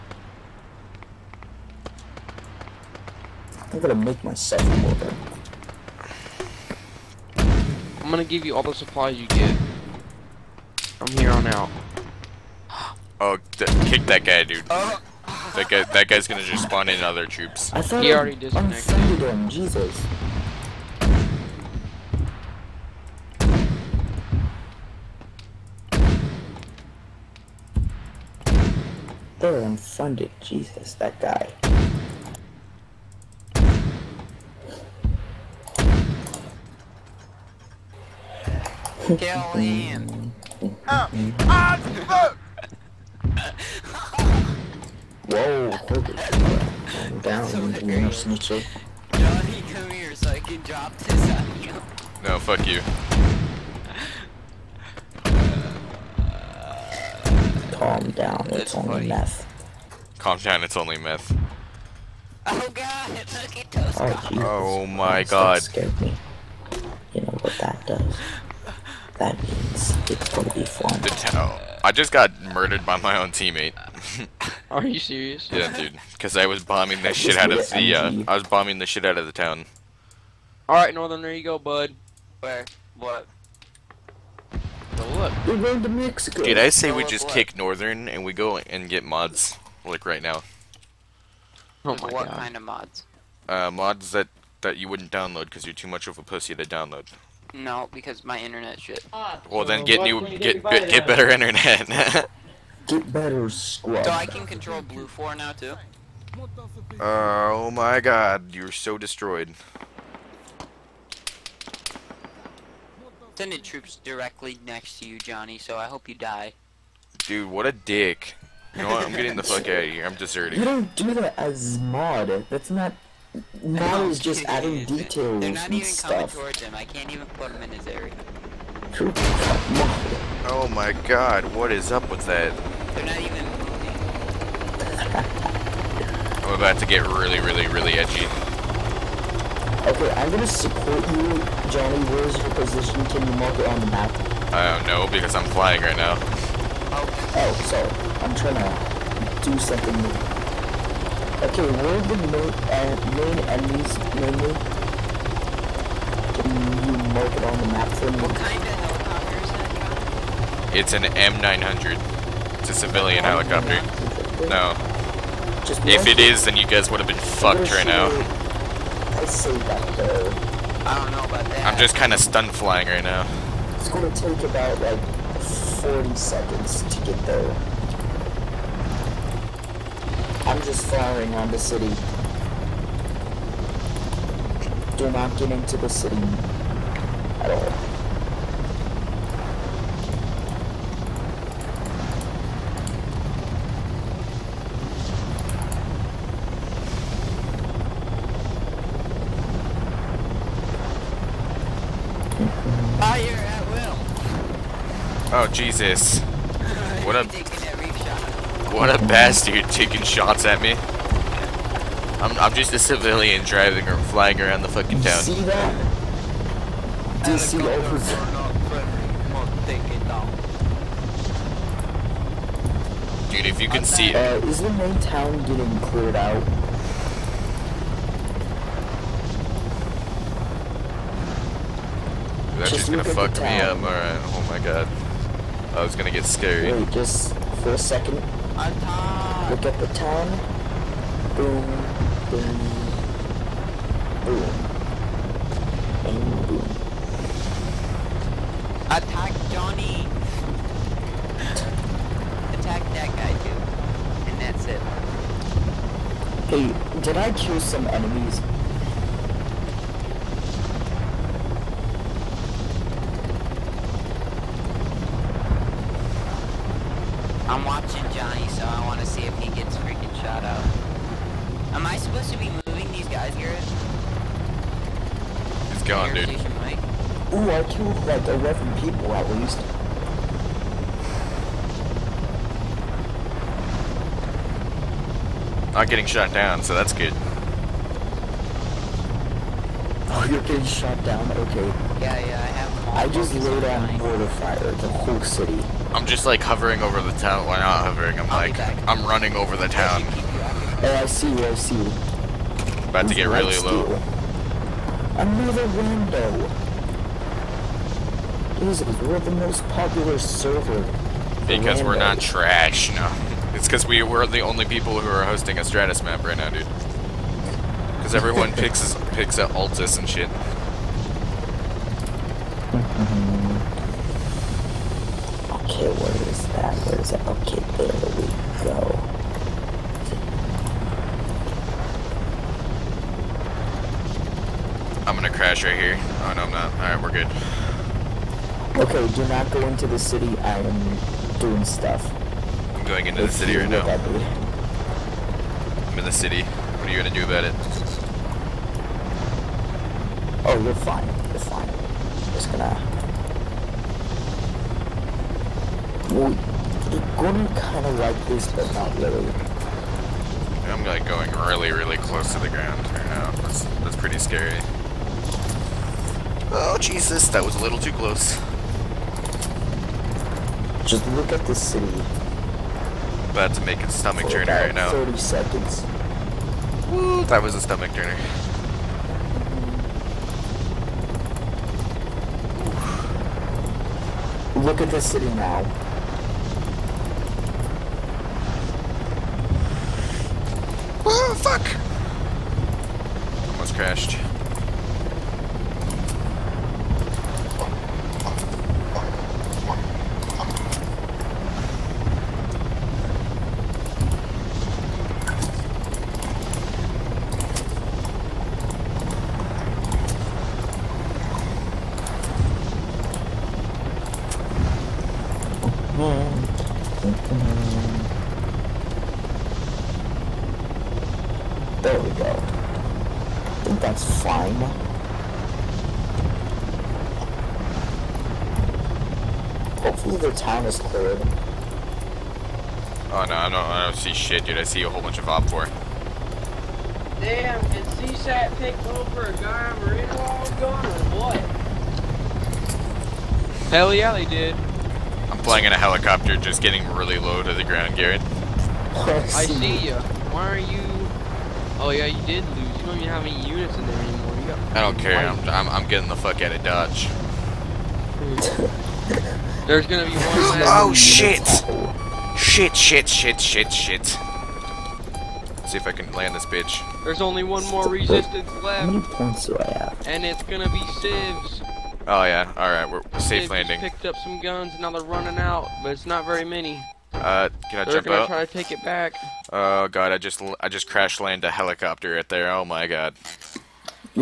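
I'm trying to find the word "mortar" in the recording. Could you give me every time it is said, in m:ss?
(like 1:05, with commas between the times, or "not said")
0:04, 4:53.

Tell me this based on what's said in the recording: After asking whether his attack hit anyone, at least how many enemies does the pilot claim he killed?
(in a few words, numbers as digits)
11.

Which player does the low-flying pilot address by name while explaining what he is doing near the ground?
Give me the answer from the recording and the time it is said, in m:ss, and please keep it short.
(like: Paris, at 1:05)
Garrett, at 7:27.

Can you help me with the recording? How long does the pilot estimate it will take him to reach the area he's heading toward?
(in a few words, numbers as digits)
40 seconds.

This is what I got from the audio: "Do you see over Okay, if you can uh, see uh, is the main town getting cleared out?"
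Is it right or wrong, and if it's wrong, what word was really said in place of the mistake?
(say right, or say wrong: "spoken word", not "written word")
wrong: "Dude", not "Okay".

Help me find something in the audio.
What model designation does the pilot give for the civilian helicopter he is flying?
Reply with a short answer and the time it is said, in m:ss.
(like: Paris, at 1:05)
M900, at 2:41.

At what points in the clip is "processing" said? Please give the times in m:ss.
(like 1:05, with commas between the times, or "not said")
not said.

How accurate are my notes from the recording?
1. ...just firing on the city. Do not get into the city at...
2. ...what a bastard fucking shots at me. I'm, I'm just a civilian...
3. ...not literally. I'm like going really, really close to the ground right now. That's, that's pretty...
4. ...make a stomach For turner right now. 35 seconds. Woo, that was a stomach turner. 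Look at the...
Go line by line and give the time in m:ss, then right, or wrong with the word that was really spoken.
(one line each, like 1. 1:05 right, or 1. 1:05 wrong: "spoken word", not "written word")
1. 3:00 right
2. 3:28 wrong: "taking", not "fucking"
3. 5:58 right
4. 6:13 wrong: "30", not "35".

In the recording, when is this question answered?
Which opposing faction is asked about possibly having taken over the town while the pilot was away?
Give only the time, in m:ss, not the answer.
7:17.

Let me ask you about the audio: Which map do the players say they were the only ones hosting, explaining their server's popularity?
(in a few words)
Stratis.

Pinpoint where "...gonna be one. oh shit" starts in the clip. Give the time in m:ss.
7:39.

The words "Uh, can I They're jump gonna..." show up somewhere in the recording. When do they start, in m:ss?
7:57.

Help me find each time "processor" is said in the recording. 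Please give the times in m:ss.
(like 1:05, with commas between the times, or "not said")
not said.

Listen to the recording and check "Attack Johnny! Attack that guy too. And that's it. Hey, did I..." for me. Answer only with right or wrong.
right.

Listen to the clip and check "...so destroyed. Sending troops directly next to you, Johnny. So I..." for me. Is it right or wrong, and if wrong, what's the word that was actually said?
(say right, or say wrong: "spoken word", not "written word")
right.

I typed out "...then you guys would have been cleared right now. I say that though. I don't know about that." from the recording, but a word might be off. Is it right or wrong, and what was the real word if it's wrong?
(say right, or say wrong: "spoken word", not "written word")
wrong: "fucked", not "cleared".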